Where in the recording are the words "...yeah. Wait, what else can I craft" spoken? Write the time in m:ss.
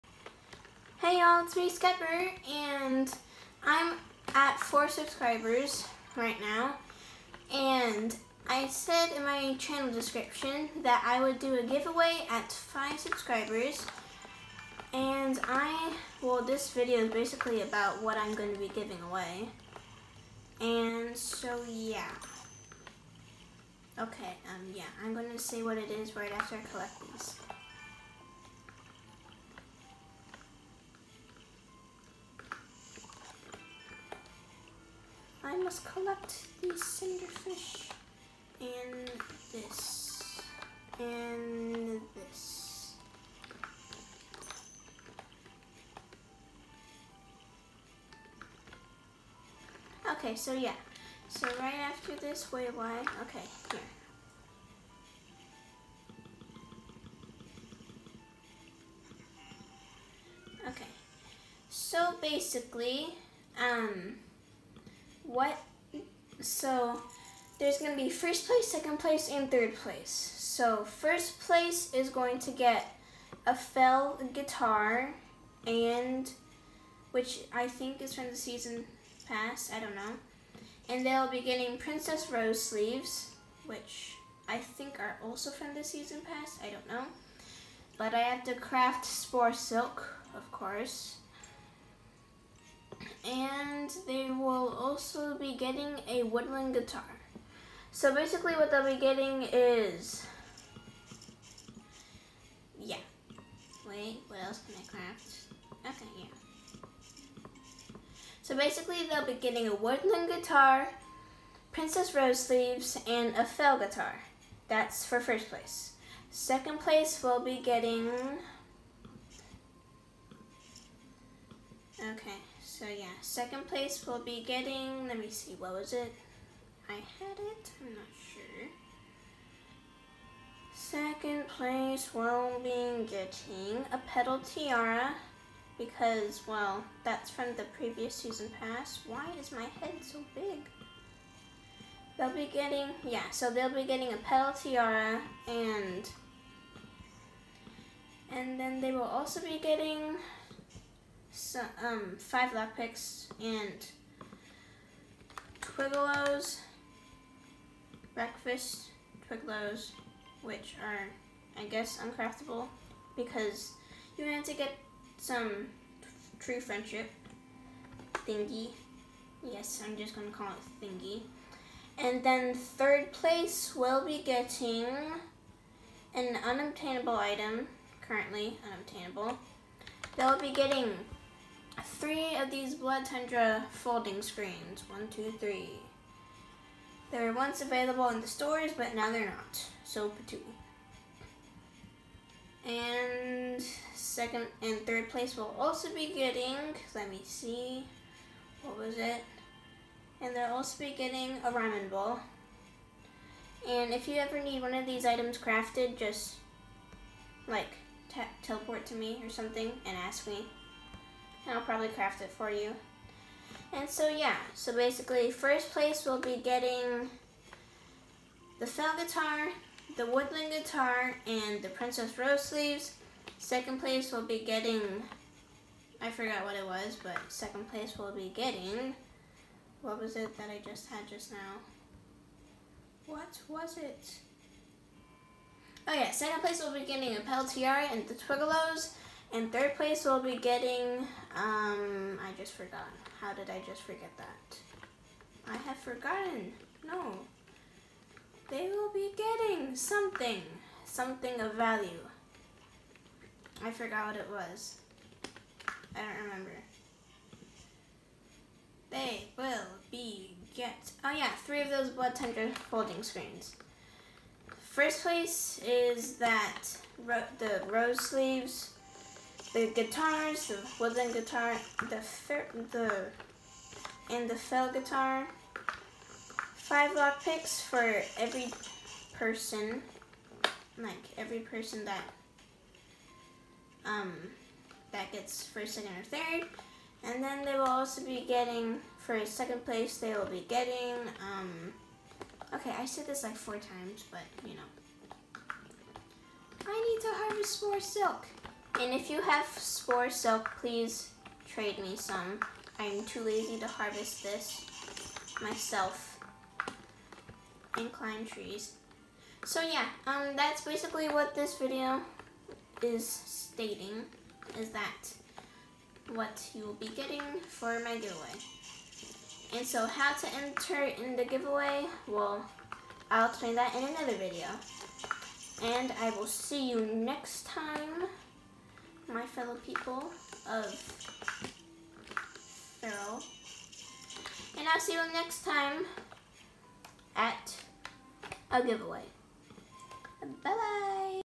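1:42.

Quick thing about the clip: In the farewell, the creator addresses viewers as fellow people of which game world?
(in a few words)
Feral.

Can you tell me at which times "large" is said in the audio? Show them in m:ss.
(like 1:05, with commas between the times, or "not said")
not said.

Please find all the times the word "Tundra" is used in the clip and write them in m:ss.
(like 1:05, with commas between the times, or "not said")
3:03, 4:22.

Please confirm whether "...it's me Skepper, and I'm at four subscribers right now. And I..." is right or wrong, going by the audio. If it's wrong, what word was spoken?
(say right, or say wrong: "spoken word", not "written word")
right.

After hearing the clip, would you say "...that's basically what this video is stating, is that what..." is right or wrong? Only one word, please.
right.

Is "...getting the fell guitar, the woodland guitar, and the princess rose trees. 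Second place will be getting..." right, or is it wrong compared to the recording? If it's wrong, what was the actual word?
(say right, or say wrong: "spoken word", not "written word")
wrong: "sleeves", not "trees".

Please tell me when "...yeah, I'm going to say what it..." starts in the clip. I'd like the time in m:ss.
0:24.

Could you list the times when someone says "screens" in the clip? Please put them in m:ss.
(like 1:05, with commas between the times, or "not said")
3:04, 4:23.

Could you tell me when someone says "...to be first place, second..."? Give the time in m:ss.
1:07.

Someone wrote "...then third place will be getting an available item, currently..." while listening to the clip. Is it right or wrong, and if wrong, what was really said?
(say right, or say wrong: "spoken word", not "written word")
wrong: "unobtainable", not "available".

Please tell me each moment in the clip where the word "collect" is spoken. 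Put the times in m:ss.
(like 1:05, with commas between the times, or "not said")
0:26, 0:35.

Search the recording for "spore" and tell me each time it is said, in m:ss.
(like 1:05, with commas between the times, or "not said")
1:29, 4:59.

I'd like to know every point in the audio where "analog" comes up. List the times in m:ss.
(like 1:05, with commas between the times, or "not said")
not said.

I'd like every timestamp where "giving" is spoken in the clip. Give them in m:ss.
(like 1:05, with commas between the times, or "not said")
0:18.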